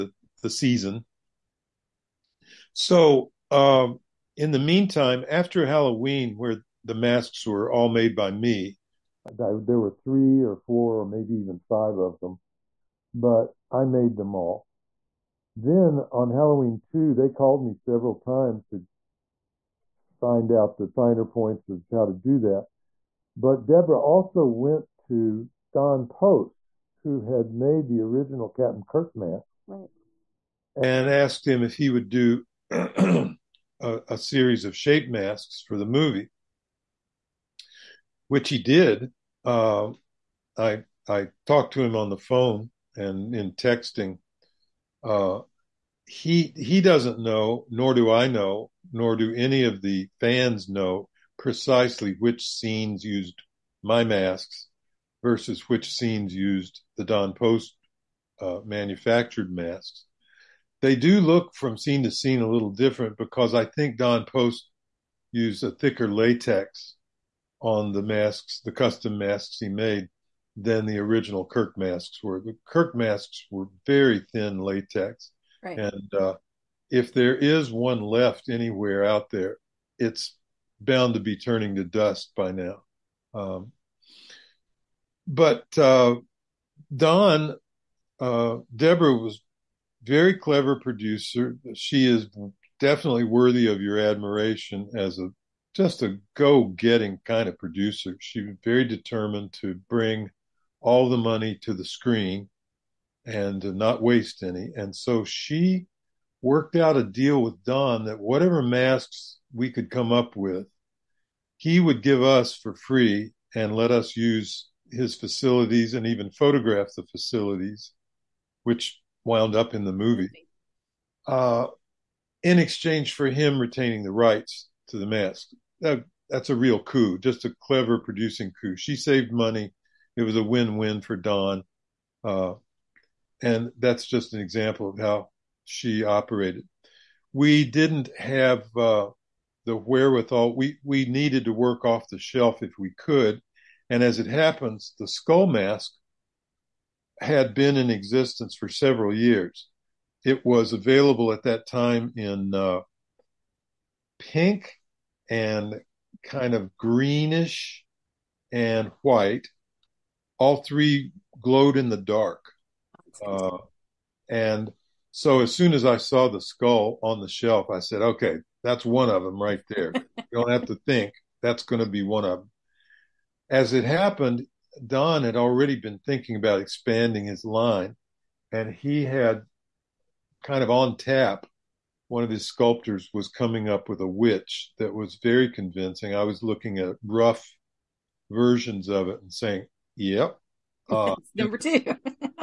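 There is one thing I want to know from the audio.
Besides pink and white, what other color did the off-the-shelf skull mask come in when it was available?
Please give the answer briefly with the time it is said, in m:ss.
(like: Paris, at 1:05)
greenish, at 2:36.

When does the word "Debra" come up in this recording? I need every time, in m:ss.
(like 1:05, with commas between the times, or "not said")
1:28.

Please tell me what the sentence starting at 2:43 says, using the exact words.
Uh, and so as soon as I saw the skull on the shelf, I said, okay, that's one of them right there.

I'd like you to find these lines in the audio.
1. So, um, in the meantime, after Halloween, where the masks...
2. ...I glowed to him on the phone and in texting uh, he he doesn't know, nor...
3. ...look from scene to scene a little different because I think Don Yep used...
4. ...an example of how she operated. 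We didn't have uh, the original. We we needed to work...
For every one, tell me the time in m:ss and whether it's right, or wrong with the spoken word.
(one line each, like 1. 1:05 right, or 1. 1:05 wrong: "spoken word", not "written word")
1. 0:02 right
2. 0:41 wrong: "talked", not "glowed"
3. 1:01 wrong: "Post", not "Yep"
4. 2:14 wrong: "wherewithal", not "original".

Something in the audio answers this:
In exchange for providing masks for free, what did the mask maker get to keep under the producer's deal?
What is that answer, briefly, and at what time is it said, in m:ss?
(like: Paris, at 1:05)
the rights to the mask, at 2:04.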